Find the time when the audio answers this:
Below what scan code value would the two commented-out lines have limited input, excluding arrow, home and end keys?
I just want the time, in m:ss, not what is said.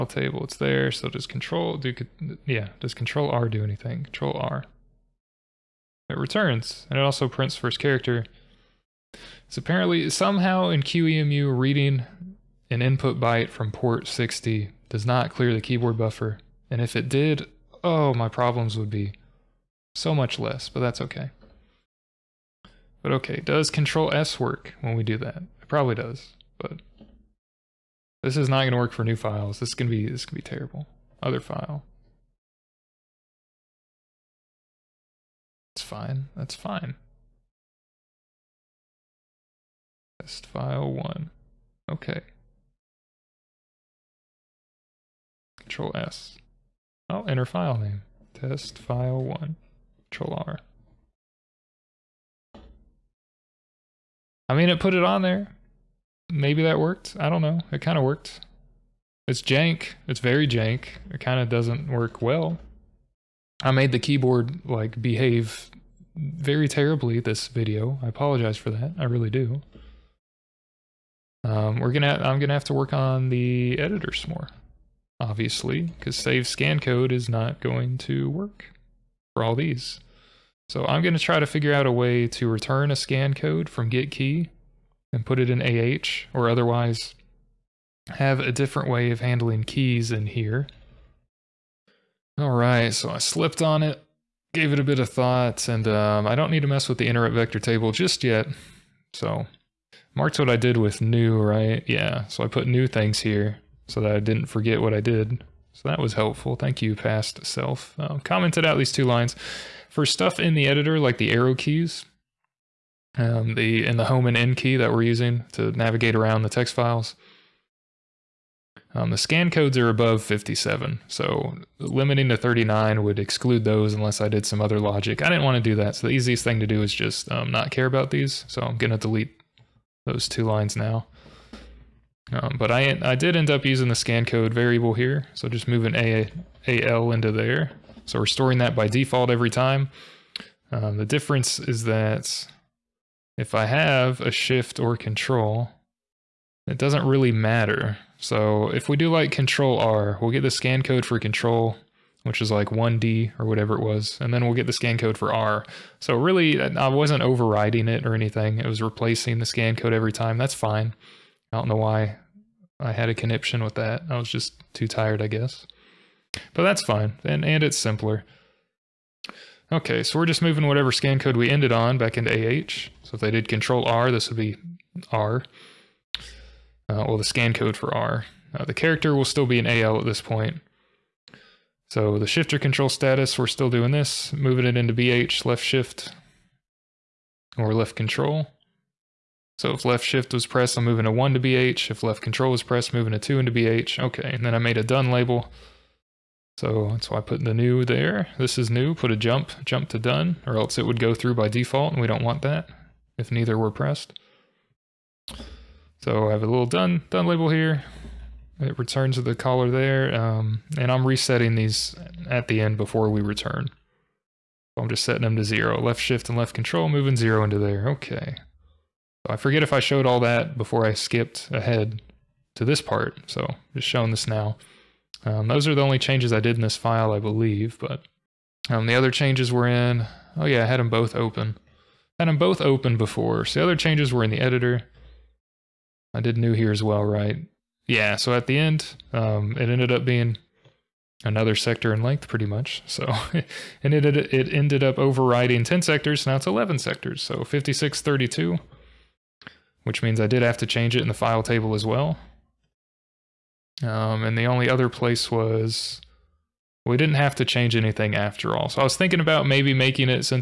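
2:02.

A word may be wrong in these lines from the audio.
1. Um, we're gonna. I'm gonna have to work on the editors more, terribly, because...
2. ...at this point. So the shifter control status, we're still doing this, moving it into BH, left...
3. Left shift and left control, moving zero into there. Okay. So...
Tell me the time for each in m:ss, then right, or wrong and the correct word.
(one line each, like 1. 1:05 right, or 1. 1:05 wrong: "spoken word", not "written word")
1. 1:11 wrong: "obviously", not "terribly"
2. 2:59 right
3. 3:35 right.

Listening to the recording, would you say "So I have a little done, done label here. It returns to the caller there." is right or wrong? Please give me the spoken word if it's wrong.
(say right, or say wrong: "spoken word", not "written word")
right.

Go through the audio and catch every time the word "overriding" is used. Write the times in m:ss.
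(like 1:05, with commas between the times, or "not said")
2:37, 4:04.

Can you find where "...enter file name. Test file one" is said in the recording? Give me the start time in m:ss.
0:47.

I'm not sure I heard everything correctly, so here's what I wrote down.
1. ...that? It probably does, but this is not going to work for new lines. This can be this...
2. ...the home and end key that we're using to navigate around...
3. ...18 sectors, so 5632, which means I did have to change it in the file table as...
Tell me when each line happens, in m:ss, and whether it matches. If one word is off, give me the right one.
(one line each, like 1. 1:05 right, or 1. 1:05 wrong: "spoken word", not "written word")
1. 0:25 wrong: "files", not "lines"
2. 1:53 right
3. 4:06 wrong: "11", not "18".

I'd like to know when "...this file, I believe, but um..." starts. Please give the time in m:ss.
3:46.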